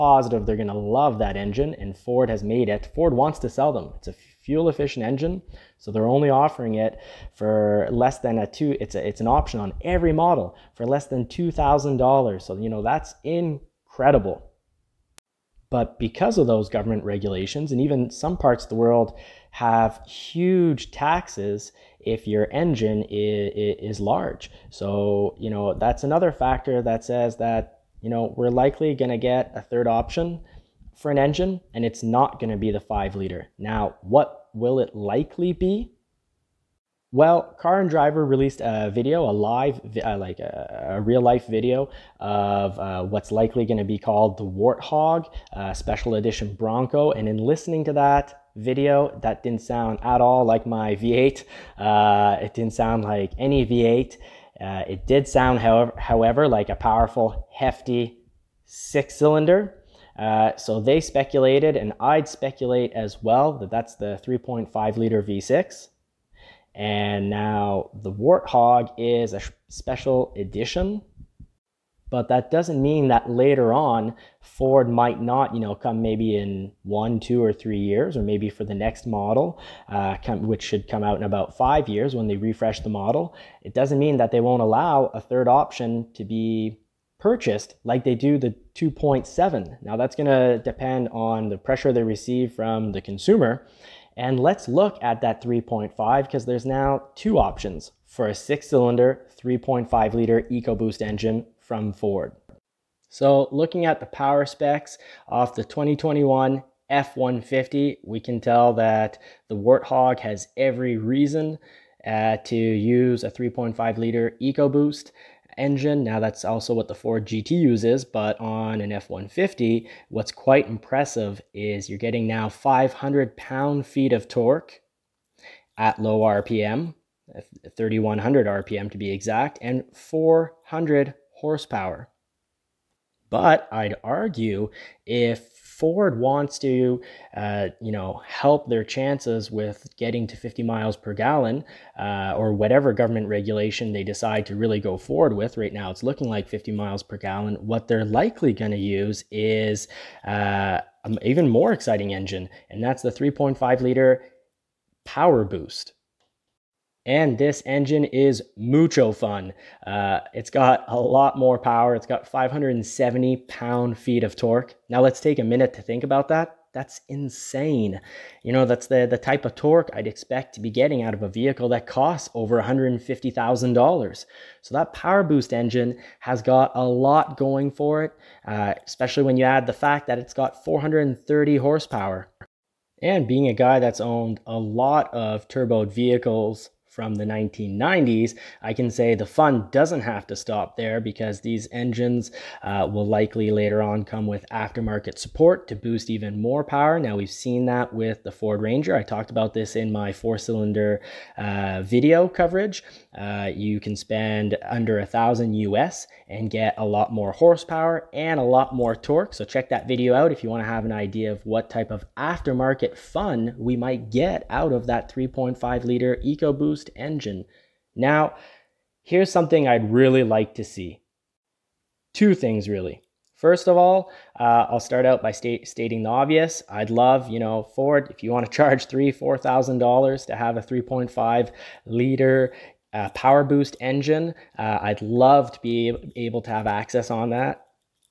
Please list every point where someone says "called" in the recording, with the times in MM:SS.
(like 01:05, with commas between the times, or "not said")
00:43.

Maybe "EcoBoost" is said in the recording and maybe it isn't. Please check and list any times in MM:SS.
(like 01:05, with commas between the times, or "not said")
01:40, 01:54, 03:36.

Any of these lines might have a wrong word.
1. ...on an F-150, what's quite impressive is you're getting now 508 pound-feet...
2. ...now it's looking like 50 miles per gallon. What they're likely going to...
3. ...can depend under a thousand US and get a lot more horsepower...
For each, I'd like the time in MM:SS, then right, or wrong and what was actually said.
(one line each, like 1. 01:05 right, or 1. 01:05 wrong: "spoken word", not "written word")
1. 01:58 wrong: "500", not "508"
2. 02:25 right
3. 03:23 wrong: "spend", not "depend".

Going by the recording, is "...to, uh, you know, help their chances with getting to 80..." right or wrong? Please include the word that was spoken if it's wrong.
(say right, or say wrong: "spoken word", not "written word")
wrong: "50", not "80".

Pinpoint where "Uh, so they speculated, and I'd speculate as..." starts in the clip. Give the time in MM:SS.
01:00.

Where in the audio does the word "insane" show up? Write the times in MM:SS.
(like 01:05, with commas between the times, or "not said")
02:47.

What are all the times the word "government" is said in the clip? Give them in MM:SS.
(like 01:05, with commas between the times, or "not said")
00:16, 02:22.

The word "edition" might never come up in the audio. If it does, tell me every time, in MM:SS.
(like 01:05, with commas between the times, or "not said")
00:46, 01:10.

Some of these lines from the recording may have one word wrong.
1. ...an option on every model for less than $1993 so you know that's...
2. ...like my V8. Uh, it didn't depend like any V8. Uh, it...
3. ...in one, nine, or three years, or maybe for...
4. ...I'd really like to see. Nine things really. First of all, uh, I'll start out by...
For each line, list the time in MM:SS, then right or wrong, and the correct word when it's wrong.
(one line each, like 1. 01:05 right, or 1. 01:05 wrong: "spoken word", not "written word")
1. 00:09 wrong: "2000", not "1993"
2. 00:50 wrong: "sound", not "depend"
3. 01:16 wrong: "two", not "nine"
4. 03:39 wrong: "Two", not "Nine".